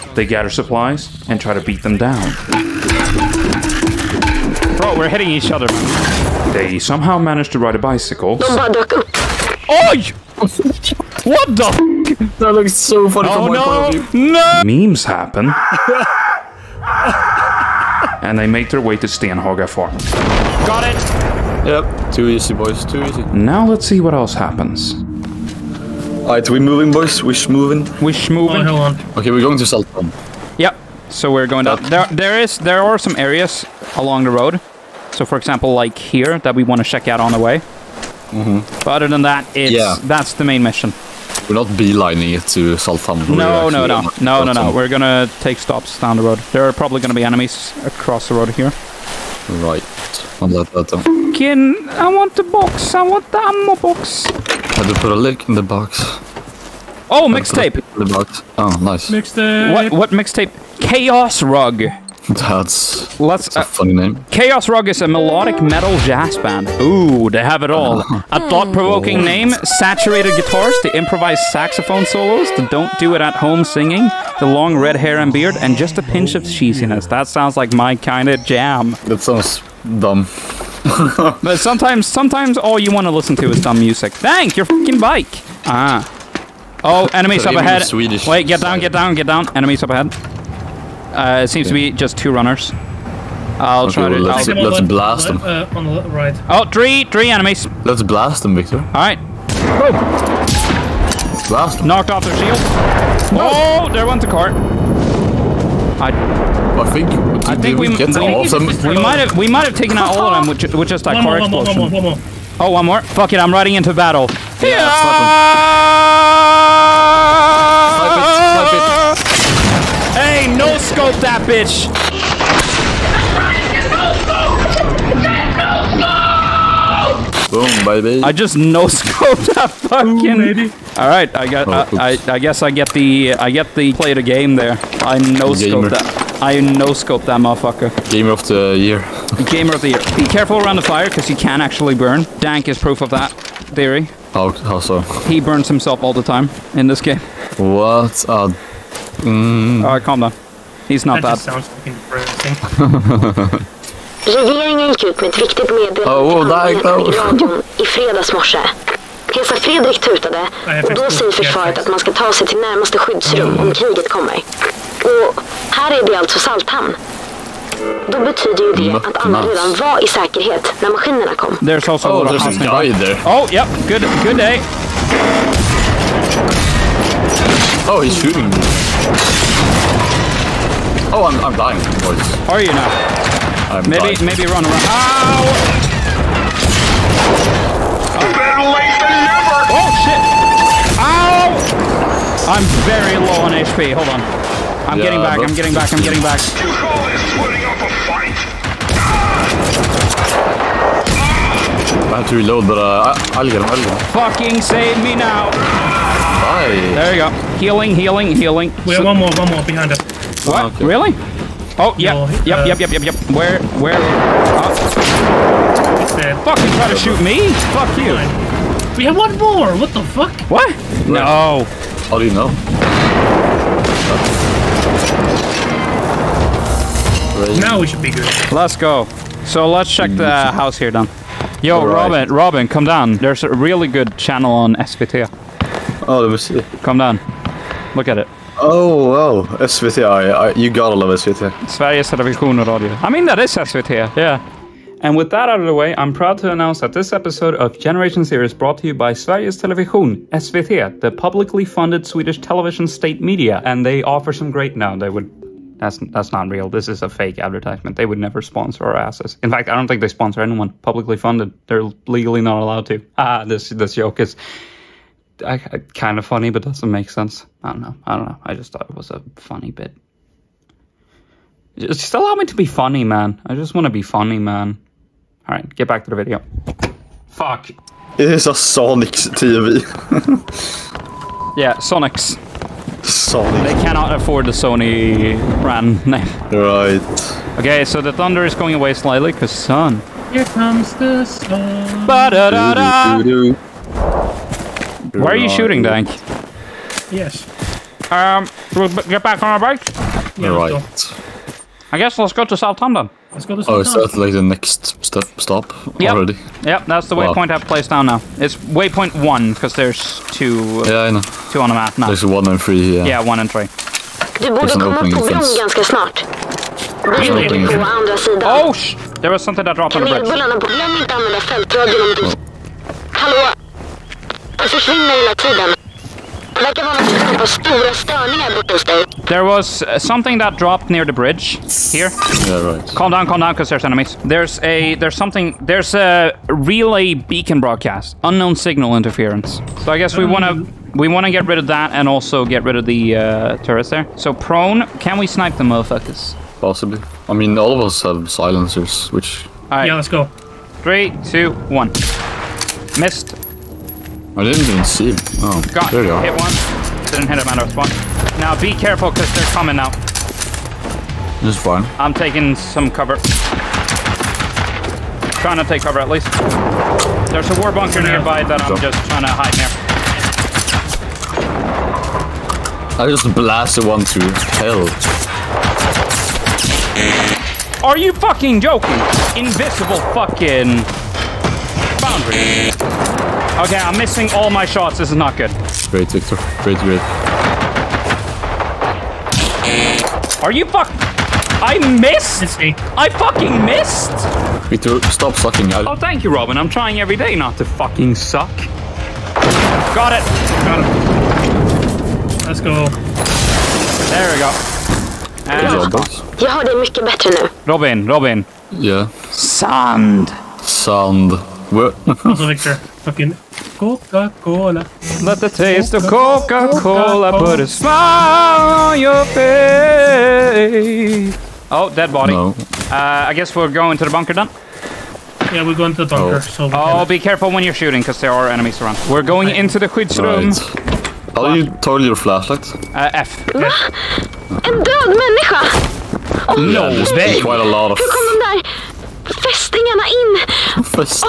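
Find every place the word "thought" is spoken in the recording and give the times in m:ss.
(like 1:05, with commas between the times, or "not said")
1:08, 4:28.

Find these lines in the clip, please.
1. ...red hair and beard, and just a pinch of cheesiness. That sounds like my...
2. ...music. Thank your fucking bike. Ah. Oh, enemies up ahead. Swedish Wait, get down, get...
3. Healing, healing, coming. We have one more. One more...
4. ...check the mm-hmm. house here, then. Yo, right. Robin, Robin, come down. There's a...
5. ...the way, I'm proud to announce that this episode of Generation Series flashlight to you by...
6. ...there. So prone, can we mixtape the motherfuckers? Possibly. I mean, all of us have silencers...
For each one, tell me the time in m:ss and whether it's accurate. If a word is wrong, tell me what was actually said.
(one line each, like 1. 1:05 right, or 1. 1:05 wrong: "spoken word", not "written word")
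1. 1:14 right
2. 1:23 right
3. 3:27 wrong: "healing", not "coming"
4. 3:49 right
5. 4:05 wrong: "brought", not "flashlight"
6. 5:43 wrong: "snipe", not "mixtape".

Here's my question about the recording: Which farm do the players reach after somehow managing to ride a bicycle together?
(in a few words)
Stenhaga Farm.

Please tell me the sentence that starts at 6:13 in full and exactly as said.
I just blasted one to hell.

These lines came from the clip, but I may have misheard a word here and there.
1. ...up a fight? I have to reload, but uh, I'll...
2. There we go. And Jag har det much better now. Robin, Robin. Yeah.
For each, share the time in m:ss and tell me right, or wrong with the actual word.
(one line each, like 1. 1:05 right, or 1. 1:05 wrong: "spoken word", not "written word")
1. 3:17 right
2. 6:44 right.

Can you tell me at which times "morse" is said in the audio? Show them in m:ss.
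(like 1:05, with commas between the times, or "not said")
2:38.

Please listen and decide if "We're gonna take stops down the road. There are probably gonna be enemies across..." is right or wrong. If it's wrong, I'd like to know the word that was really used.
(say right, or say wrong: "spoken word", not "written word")
right.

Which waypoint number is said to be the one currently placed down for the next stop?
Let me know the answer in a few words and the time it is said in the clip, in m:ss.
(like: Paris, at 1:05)
1, at 5:08.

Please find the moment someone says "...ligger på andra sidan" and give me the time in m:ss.
5:17.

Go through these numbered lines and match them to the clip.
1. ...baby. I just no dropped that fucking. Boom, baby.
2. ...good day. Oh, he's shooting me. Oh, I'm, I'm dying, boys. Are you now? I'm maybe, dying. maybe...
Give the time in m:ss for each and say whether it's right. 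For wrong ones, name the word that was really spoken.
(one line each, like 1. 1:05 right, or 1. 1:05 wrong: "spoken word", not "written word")
1. 2:08 wrong: "scoped", not "dropped"
2. 2:54 right.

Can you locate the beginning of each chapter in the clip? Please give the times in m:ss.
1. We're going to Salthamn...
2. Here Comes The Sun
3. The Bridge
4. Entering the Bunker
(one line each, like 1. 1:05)
1. 0:25
2. 4:37
3. 5:14
4. 7:02.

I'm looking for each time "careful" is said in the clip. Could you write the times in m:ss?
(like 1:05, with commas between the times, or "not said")
2:20, 5:58, 7:07.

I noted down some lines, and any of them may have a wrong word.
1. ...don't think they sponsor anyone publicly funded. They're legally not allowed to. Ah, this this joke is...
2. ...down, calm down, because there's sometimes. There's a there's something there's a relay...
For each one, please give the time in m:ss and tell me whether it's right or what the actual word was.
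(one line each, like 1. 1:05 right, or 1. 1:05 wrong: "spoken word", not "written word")
1. 4:19 right
2. 5:33 wrong: "enemies", not "sometimes".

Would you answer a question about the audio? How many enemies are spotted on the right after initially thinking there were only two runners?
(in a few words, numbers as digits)
3.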